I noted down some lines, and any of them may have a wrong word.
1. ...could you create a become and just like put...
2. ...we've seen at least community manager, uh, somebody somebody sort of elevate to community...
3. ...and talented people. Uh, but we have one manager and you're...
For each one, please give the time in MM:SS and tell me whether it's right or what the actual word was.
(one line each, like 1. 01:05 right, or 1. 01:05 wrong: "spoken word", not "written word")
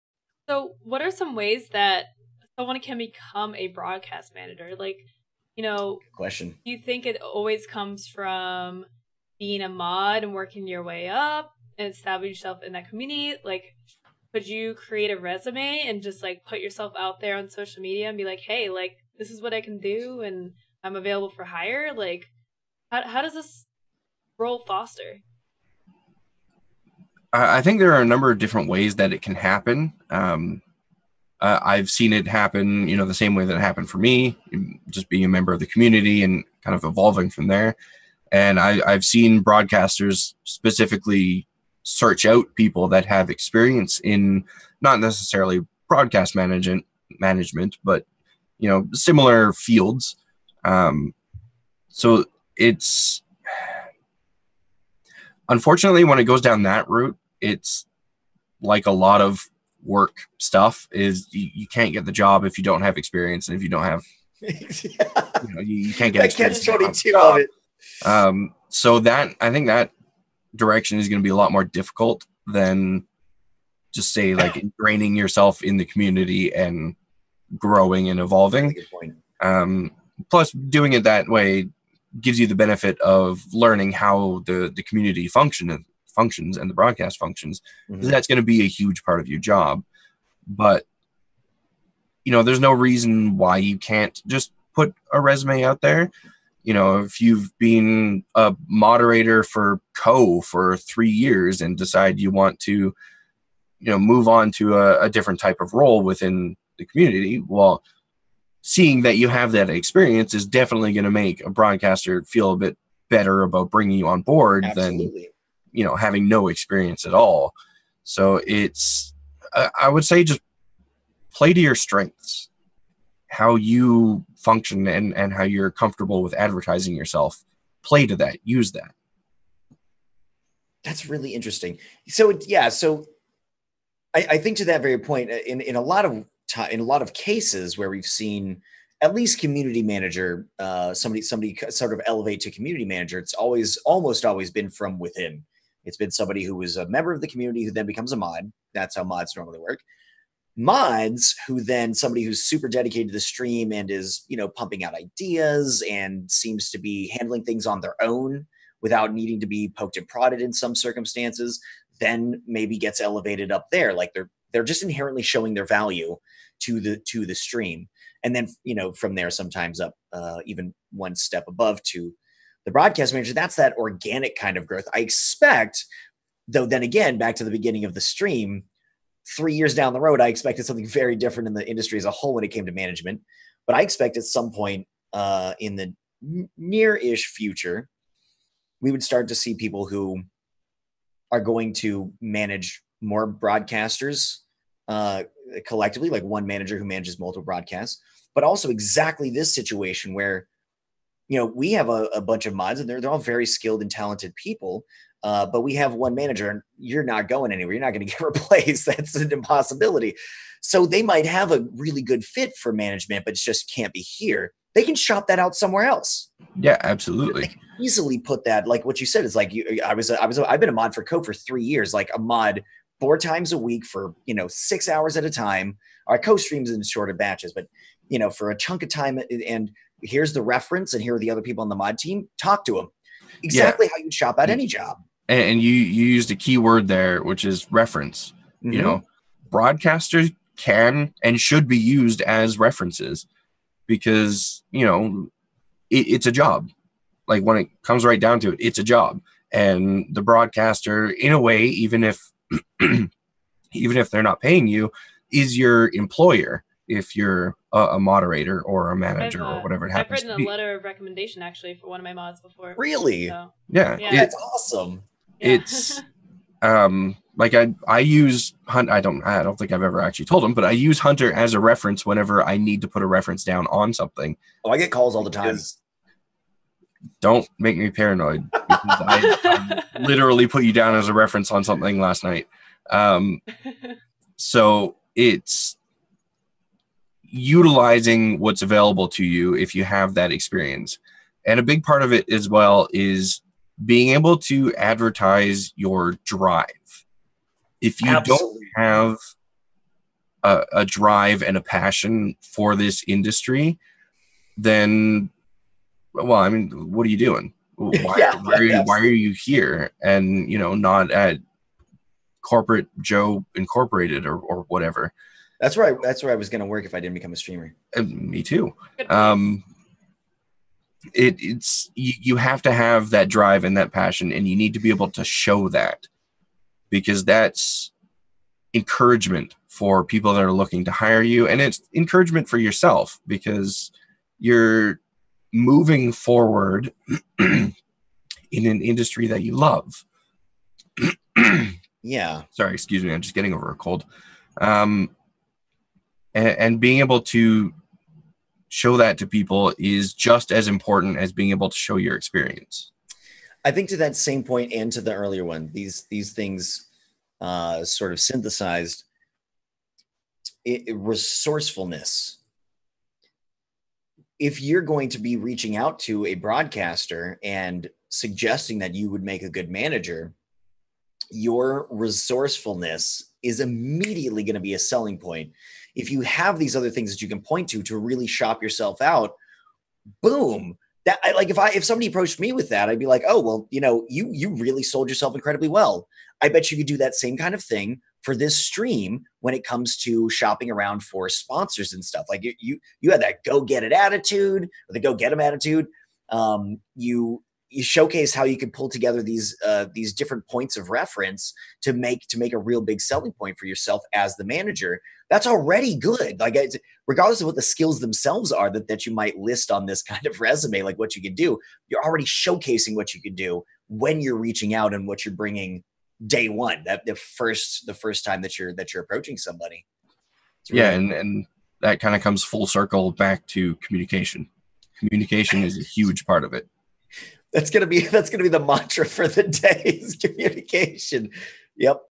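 1. 00:14 wrong: "resume", not "become"
2. 02:17 right
3. 03:23 right.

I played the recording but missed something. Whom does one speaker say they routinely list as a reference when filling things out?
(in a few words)
Hunter.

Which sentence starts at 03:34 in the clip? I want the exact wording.
They can shop that out somewhere else.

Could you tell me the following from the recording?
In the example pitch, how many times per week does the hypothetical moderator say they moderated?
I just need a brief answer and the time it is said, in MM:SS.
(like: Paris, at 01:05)
4 times, at 03:42.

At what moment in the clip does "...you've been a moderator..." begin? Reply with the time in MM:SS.
01:37.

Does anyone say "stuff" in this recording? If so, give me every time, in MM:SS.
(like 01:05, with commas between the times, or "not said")
01:00, 06:32.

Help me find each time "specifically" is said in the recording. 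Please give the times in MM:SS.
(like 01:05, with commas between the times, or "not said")
00:40.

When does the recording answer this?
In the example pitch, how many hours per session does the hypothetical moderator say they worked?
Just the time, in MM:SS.
03:44.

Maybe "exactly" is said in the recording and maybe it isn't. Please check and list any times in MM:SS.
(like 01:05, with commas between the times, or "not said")
03:18, 03:53.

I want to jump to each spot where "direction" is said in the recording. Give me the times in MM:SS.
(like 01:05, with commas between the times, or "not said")
01:10.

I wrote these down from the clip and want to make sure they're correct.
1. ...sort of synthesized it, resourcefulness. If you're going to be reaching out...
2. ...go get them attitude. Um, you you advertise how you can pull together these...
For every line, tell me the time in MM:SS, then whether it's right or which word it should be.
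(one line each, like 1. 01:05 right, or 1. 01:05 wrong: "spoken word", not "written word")
1. 05:57 right
2. 06:34 wrong: "showcase", not "advertise".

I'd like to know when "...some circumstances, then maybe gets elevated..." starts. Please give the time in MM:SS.
02:40.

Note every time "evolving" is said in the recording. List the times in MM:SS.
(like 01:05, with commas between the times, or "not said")
00:36, 01:18.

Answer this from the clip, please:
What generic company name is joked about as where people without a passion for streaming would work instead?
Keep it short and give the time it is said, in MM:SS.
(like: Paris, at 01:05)
Joe Incorporated, at 05:13.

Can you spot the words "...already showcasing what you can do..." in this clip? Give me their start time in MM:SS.
06:52.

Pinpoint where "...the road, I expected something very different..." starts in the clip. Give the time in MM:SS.
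02:59.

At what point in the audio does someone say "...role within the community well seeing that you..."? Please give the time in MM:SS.
01:45.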